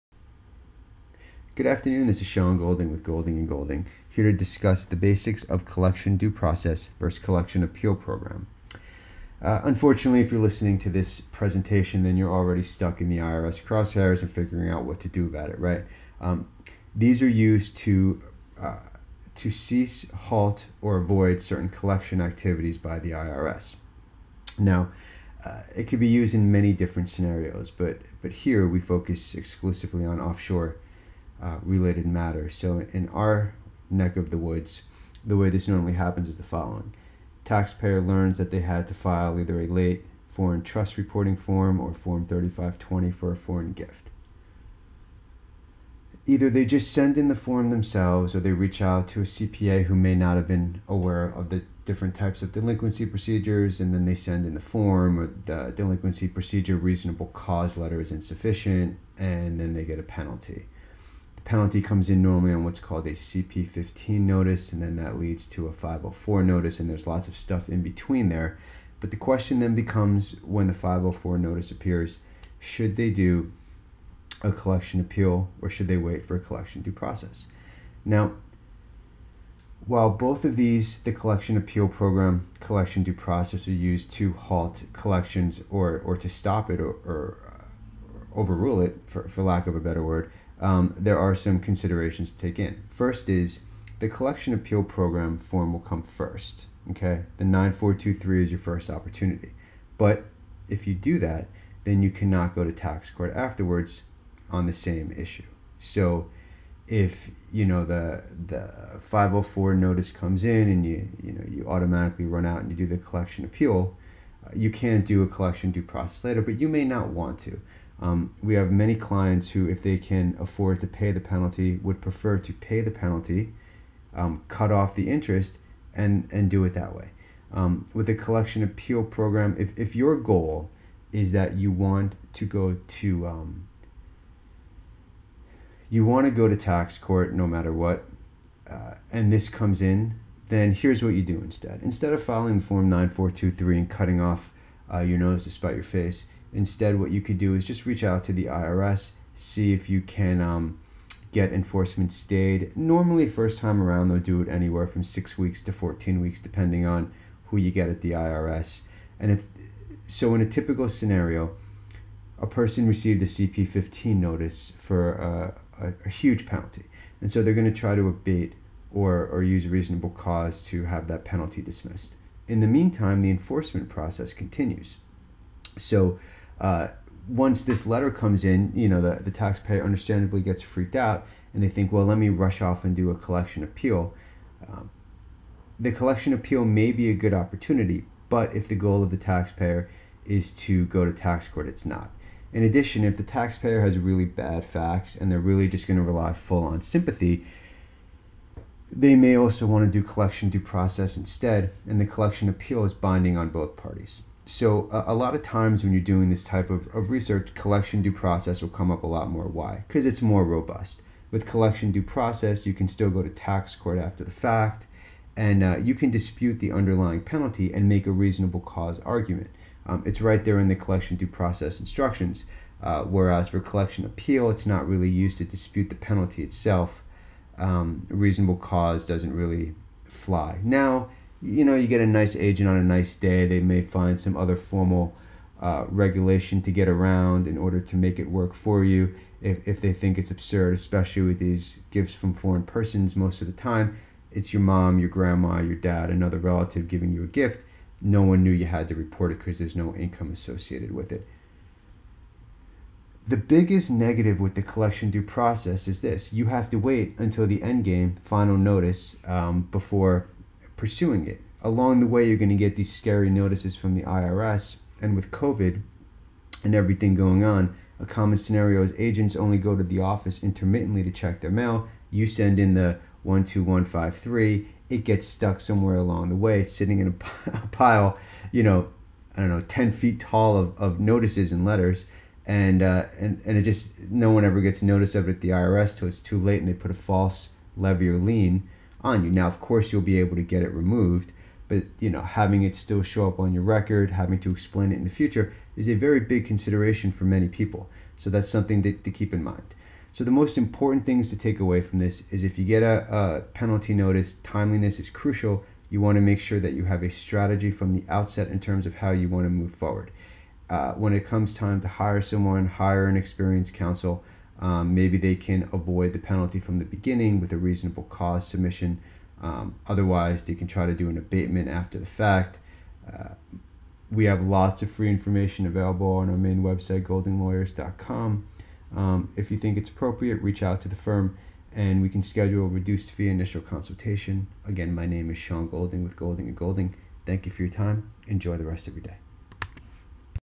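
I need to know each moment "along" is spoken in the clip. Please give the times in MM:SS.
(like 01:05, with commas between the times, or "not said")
04:21, 04:35.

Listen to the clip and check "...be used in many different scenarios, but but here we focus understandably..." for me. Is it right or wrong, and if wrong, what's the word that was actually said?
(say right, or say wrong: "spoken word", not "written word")
wrong: "exclusively", not "understandably".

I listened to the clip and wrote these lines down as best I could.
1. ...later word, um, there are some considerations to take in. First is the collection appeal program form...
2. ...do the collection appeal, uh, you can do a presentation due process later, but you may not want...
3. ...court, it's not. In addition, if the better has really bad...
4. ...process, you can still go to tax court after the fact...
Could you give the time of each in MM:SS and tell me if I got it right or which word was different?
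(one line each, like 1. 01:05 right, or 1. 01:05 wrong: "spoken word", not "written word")
1. 01:29 wrong: "better", not "later"
2. 01:52 wrong: "collection", not "presentation"
3. 03:11 wrong: "taxpayer", not "better"
4. 03:32 right.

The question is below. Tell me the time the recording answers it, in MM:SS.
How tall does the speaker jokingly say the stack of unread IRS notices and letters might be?
04:39.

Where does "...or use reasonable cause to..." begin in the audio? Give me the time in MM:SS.
02:49.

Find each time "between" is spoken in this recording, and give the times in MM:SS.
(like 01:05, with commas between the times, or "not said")
01:07.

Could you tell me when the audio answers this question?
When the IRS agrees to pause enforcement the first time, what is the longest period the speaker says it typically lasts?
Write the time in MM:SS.
02:35.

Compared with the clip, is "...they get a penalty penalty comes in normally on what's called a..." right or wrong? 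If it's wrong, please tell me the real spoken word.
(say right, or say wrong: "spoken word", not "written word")
right.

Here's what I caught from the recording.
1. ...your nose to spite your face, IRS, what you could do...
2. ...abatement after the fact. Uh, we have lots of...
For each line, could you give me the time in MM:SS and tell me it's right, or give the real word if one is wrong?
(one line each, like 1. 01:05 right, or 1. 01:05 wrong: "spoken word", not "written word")
1. 02:24 wrong: "Instead", not "IRS"
2. 05:21 right.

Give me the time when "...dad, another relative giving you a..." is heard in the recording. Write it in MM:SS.
04:05.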